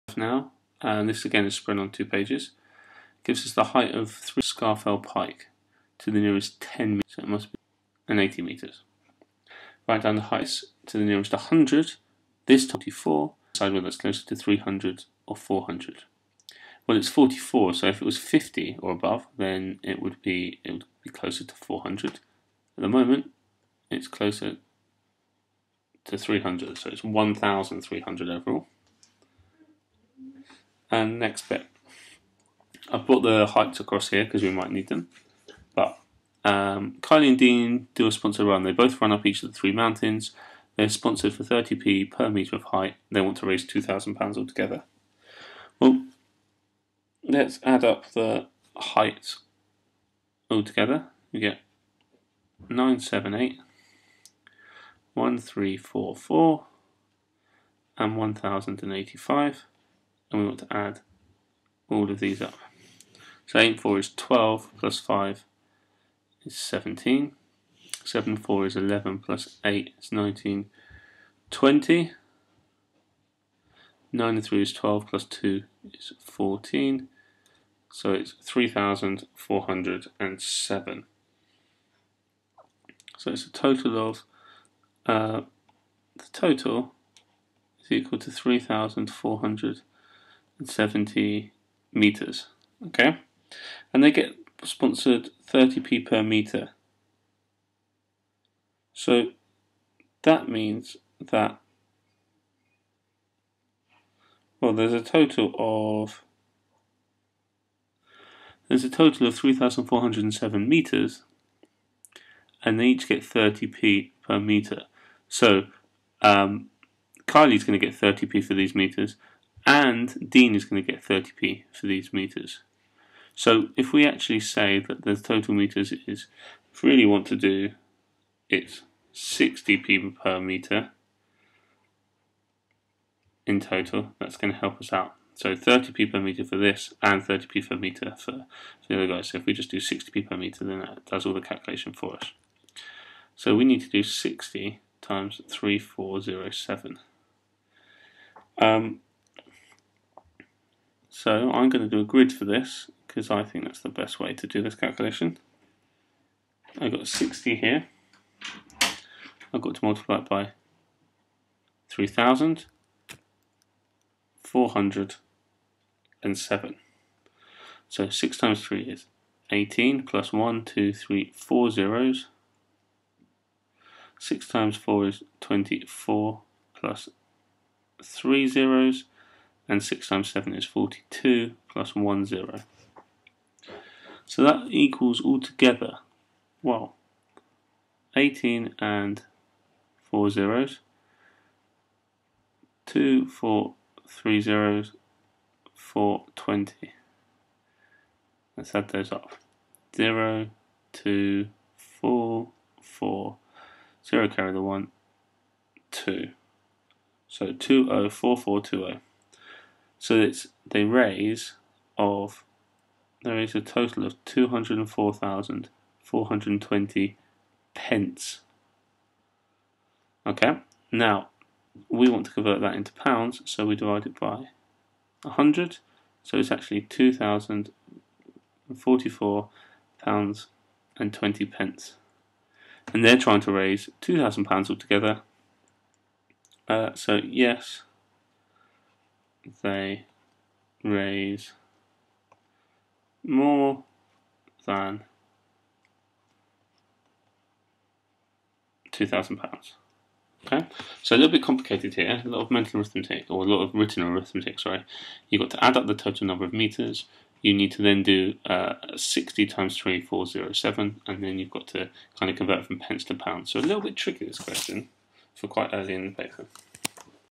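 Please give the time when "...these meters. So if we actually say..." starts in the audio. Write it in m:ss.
2:01.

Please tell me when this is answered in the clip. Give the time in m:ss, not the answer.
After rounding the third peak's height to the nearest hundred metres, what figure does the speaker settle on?
0:27.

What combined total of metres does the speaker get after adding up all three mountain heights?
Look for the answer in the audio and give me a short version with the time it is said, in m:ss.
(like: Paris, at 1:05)
3,407 meters, at 1:49.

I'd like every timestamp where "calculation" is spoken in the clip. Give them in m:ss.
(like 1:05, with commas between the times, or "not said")
2:21, 2:34.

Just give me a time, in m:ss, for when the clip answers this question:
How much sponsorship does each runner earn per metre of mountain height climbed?
0:41.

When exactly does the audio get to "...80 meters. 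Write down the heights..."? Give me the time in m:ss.
0:08.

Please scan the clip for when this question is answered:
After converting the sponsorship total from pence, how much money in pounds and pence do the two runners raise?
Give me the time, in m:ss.
3:46.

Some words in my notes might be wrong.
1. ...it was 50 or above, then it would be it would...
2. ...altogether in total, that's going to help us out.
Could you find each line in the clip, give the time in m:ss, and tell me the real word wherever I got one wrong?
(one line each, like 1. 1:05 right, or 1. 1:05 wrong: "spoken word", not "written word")
1. 0:18 right
2. 2:10 wrong: "meter", not "altogether".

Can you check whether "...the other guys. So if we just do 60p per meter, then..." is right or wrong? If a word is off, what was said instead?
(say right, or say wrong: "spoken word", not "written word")
right.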